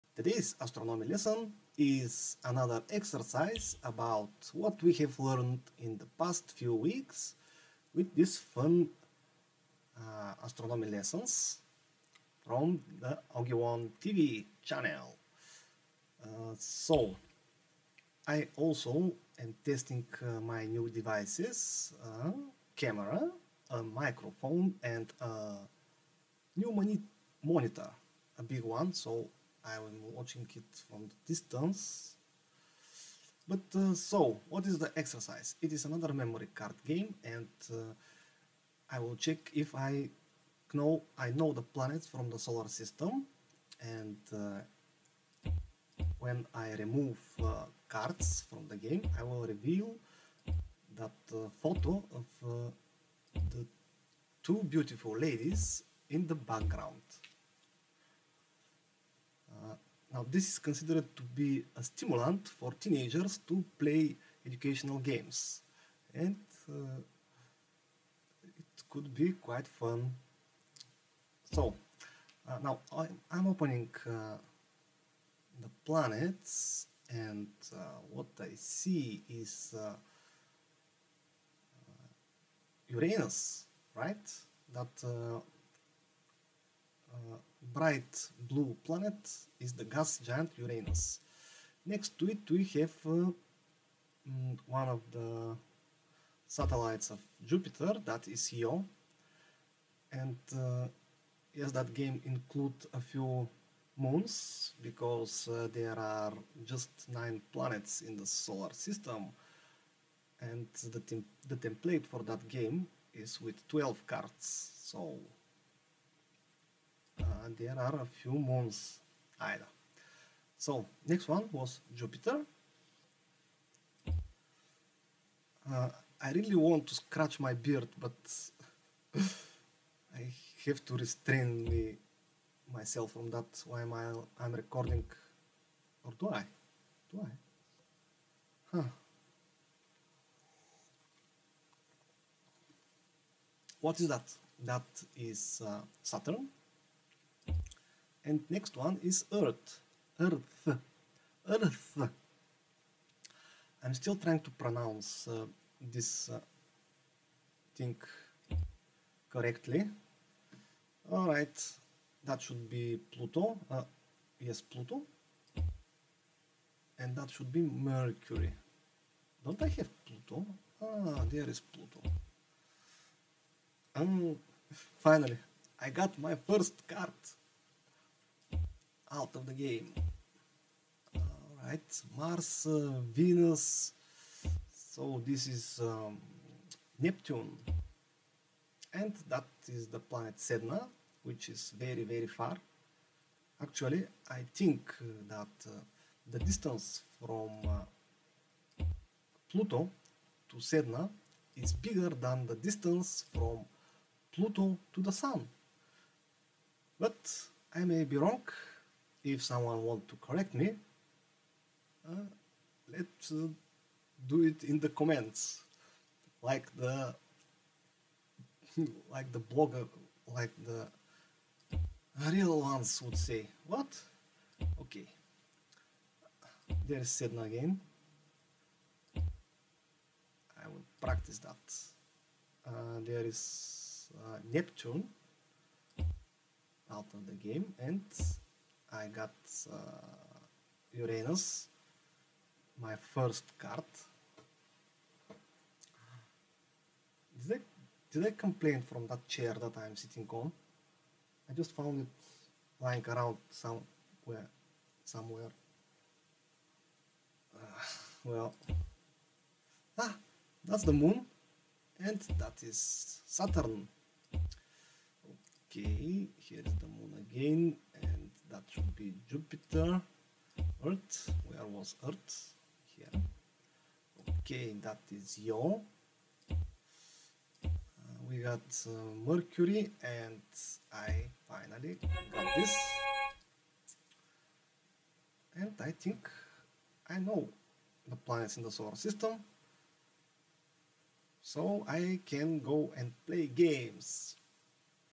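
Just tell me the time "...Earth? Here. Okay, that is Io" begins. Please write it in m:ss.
4:32.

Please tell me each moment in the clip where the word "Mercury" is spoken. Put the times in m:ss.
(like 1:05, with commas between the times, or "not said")
2:47, 4:39.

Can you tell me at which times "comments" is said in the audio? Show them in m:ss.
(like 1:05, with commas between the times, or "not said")
3:34.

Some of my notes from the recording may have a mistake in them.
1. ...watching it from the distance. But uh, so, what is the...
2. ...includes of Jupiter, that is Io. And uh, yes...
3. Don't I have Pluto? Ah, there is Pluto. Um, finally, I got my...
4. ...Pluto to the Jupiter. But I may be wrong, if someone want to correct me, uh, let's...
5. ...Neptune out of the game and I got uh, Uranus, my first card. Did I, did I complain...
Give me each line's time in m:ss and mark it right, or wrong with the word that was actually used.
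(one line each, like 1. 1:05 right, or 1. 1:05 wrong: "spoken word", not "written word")
1. 0:30 right
2. 1:36 wrong: "satellites", not "includes"
3. 2:49 right
4. 3:24 wrong: "Sun", not "Jupiter"
5. 3:54 right.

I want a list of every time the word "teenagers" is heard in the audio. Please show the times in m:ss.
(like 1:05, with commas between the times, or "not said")
1:02.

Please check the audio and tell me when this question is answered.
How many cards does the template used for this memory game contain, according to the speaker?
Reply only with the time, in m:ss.
1:53.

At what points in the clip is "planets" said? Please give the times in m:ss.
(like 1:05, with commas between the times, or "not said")
0:41, 1:15, 1:28, 1:47, 3:09, 4:48.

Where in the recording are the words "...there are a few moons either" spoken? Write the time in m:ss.
1:57.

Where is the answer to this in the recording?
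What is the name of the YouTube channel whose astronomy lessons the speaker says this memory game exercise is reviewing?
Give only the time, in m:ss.
0:13.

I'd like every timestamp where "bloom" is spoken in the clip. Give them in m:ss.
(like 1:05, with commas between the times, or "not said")
not said.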